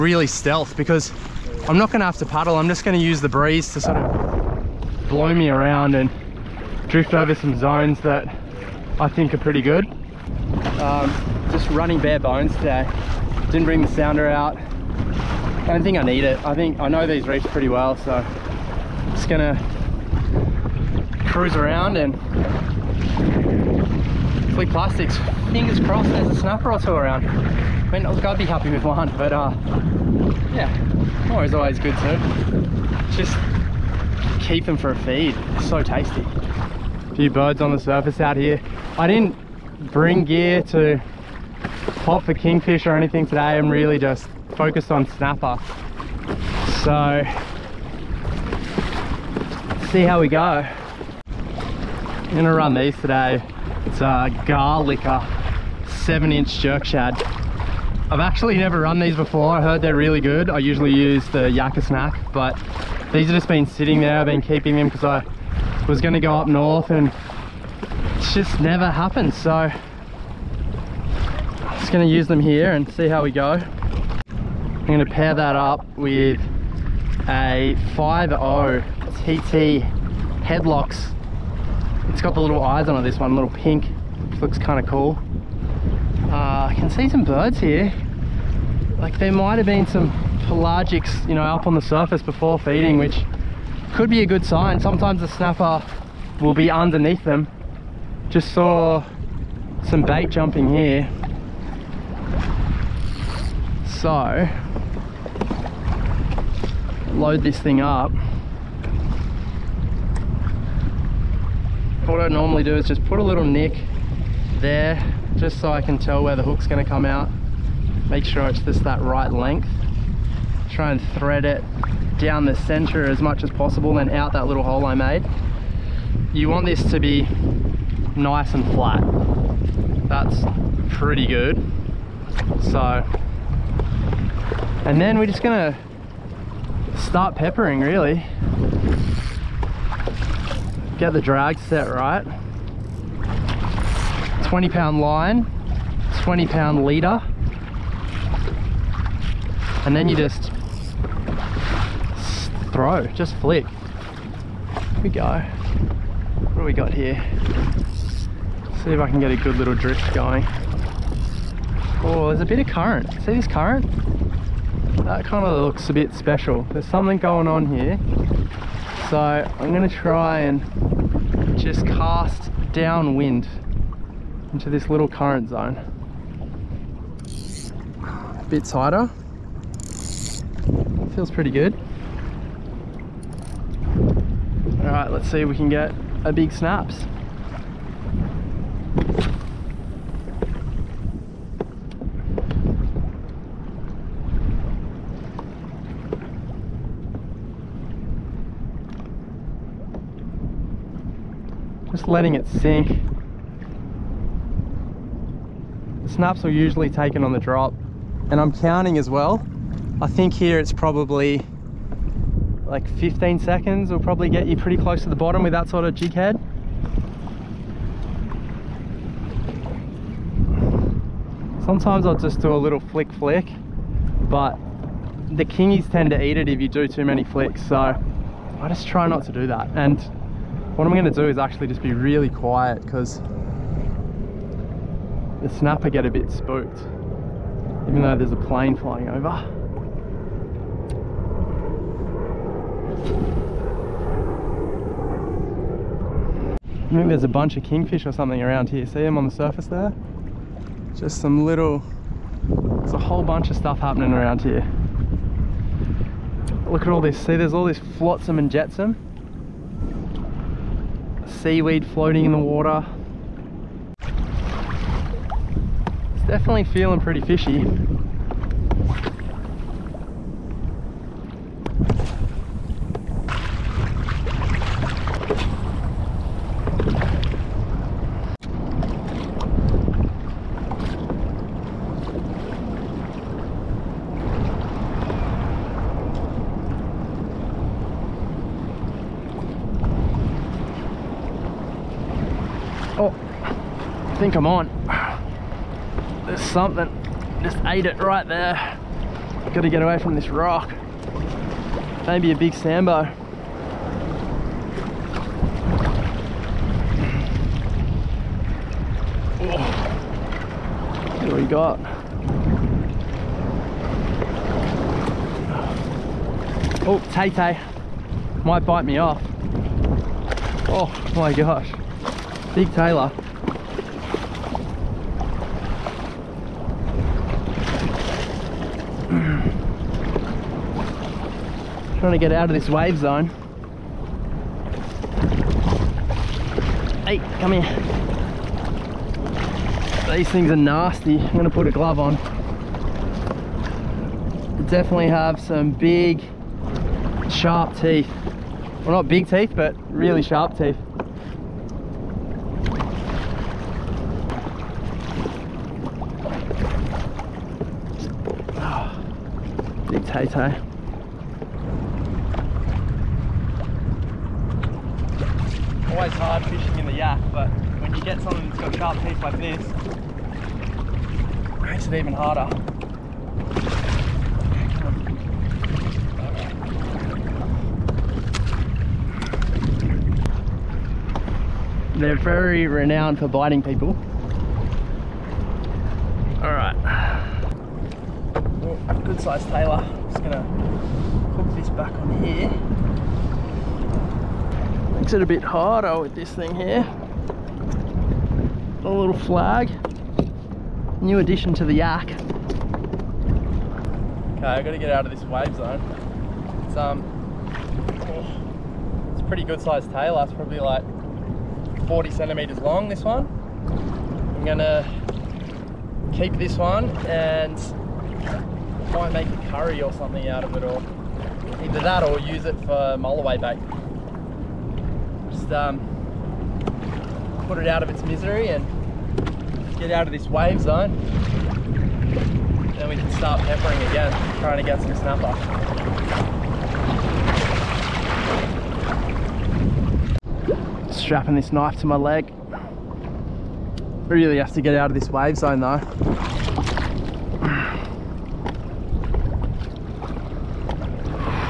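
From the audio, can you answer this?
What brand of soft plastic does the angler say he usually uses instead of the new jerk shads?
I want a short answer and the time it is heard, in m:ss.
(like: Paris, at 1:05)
Yakka snack, at 1:01.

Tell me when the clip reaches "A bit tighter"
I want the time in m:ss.
2:58.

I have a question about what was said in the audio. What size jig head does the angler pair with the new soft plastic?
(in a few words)
5.0.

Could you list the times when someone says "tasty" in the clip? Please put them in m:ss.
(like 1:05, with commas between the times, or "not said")
0:35.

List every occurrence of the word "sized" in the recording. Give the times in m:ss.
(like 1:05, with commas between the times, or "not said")
6:29, 6:49.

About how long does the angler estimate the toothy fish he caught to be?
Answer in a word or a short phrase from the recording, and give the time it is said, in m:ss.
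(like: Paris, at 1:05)
40 centimeters, at 6:51.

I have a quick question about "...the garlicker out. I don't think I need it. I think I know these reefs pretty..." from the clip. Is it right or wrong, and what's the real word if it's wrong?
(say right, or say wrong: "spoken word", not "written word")
wrong: "sounder", not "garlicker".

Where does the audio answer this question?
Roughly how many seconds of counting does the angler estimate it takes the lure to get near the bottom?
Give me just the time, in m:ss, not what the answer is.
3:32.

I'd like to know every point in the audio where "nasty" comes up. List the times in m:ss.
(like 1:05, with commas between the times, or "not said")
5:40.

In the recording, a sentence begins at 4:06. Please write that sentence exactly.
I think there's a bunch of kingfish or something around here.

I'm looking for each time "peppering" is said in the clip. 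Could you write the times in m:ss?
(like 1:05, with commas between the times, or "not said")
2:17, 7:13.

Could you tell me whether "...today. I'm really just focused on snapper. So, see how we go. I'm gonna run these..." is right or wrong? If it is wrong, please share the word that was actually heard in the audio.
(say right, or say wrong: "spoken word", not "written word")
right.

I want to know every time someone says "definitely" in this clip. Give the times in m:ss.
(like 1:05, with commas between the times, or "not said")
4:26, 5:44.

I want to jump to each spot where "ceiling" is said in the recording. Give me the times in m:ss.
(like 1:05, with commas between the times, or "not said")
not said.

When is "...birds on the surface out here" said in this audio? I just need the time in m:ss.
0:37.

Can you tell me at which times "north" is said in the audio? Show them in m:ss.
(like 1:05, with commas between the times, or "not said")
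1:06.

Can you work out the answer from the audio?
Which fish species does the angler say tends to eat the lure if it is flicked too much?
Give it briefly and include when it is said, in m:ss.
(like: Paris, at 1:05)
kingies, at 3:45.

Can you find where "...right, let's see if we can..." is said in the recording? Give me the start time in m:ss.
3:04.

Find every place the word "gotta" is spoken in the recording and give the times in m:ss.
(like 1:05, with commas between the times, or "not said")
4:59, 6:44.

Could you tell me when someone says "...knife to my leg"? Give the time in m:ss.
7:21.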